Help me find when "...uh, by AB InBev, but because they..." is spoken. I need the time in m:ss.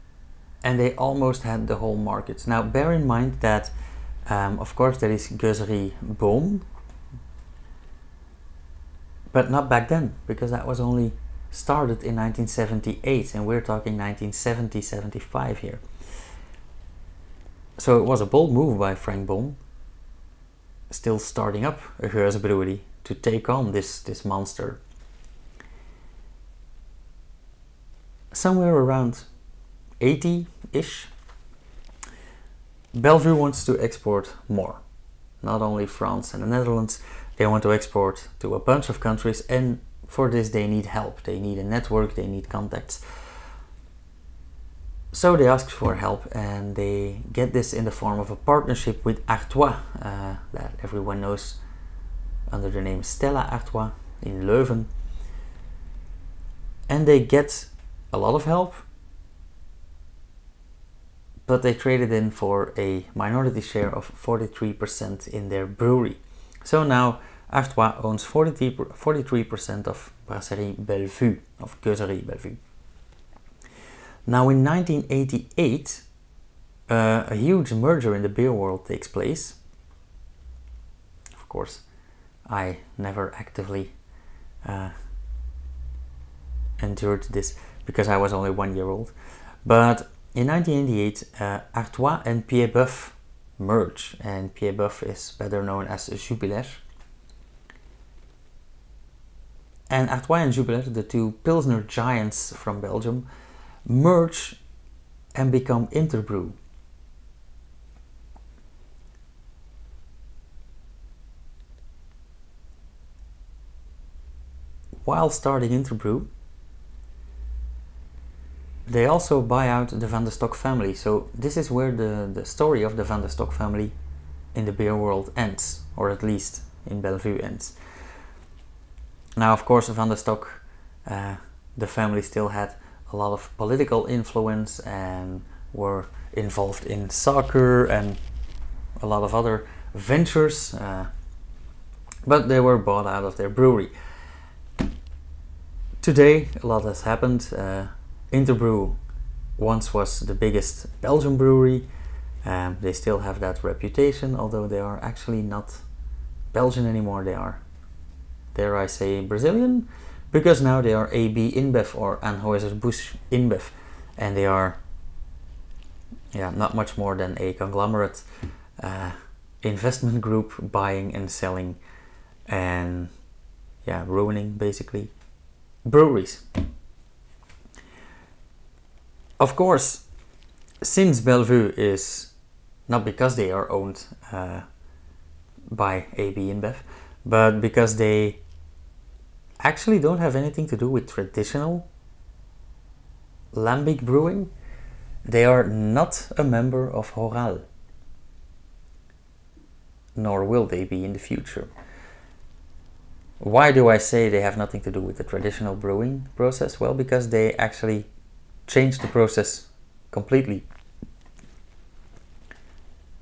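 3:04.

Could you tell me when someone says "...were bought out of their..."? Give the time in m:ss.
2:22.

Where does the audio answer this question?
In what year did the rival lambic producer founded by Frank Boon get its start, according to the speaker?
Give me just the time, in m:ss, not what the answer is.
0:12.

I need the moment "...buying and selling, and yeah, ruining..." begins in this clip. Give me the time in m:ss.
2:50.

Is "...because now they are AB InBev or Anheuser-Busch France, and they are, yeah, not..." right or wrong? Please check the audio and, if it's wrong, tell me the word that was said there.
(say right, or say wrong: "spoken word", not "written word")
wrong: "InBev", not "France".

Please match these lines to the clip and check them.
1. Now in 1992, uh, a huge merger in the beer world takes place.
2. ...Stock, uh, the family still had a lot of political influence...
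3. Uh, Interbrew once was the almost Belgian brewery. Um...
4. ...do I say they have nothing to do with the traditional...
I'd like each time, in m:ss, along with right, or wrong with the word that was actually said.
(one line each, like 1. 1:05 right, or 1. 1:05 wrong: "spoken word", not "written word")
1. 1:14 wrong: "1988", not "1992"
2. 2:10 right
3. 2:27 wrong: "biggest", not "almost"
4. 3:23 right.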